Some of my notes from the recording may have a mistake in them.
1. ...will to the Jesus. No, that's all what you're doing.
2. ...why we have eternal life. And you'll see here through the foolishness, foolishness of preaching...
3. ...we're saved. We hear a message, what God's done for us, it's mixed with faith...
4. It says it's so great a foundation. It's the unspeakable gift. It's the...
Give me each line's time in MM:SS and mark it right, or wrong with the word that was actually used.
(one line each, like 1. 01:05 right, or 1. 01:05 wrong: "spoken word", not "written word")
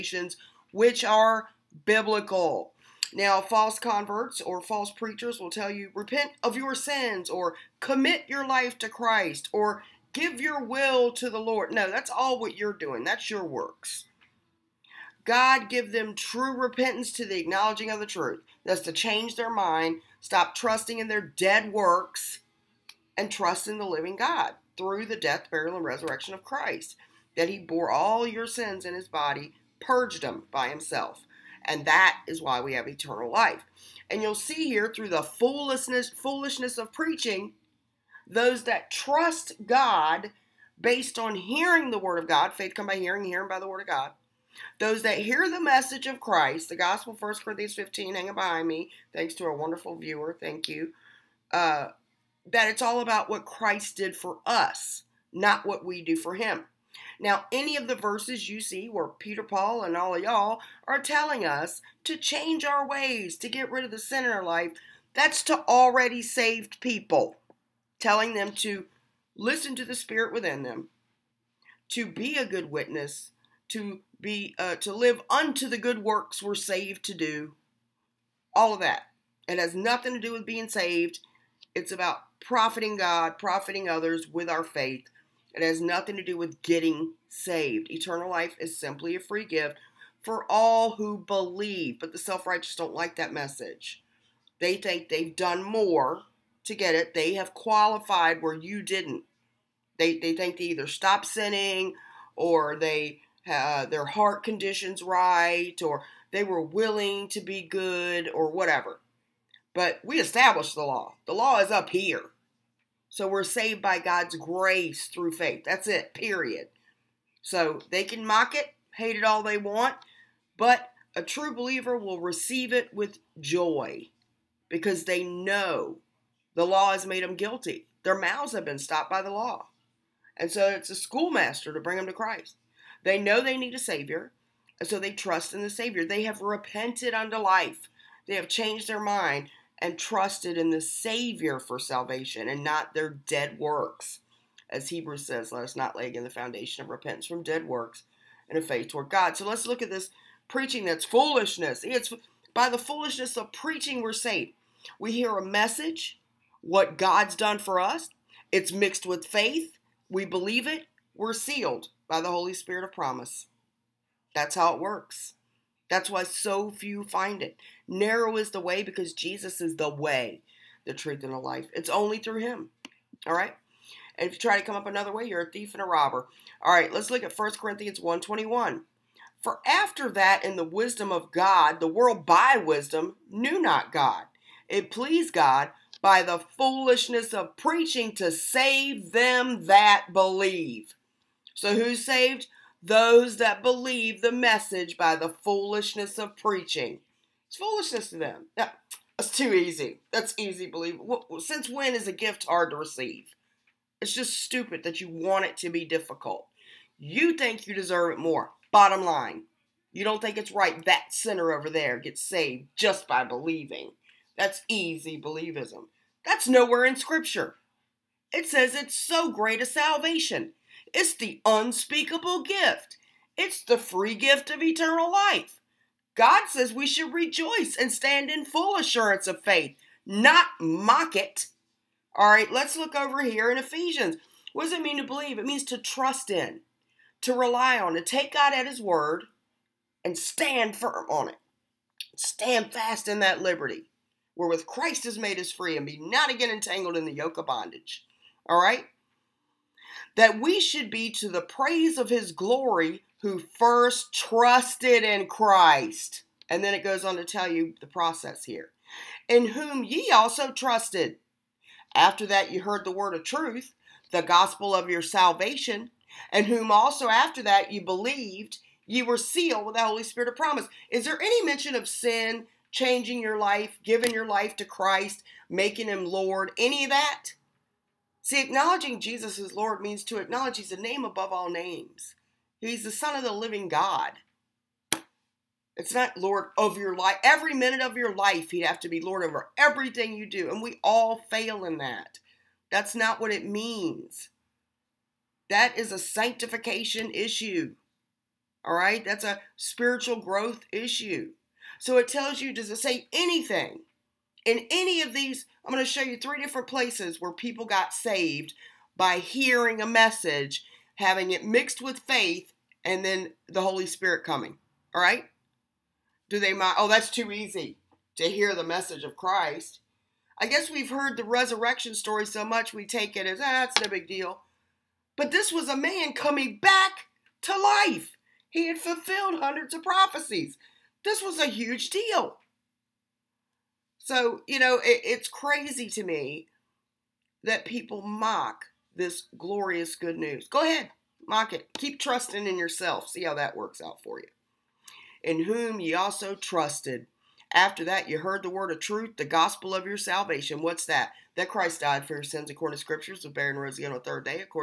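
1. 00:10 wrong: "Lord", not "Jesus"
2. 00:32 right
3. 02:34 right
4. 03:38 wrong: "salvation", not "foundation".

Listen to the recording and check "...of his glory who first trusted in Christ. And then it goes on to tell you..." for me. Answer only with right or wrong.
right.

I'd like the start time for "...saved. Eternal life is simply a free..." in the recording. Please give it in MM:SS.
01:27.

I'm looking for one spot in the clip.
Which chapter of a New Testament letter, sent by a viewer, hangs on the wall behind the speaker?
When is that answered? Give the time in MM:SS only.
00:47.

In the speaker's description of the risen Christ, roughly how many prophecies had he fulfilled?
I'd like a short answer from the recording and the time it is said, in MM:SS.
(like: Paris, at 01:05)
hundreds, at 05:29.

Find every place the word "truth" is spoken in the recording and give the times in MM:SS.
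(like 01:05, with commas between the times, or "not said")
00:18, 02:50, 04:23, 05:48.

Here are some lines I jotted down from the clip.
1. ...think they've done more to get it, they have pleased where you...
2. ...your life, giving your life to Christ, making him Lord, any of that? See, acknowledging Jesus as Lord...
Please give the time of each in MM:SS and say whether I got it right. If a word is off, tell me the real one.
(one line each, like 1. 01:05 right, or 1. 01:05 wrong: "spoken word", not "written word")
1. 01:34 wrong: "qualified", not "pleased"
2. 04:33 right.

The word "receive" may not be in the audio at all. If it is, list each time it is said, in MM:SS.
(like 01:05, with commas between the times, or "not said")
02:02, 03:22.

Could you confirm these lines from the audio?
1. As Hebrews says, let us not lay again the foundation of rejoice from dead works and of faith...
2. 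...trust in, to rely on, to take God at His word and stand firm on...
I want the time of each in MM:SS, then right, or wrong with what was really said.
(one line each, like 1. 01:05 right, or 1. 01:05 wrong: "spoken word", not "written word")
1. 02:24 wrong: "repentance", not "rejoice"
2. 03:55 right.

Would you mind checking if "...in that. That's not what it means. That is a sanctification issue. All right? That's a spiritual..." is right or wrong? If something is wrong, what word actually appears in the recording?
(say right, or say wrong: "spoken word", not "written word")
right.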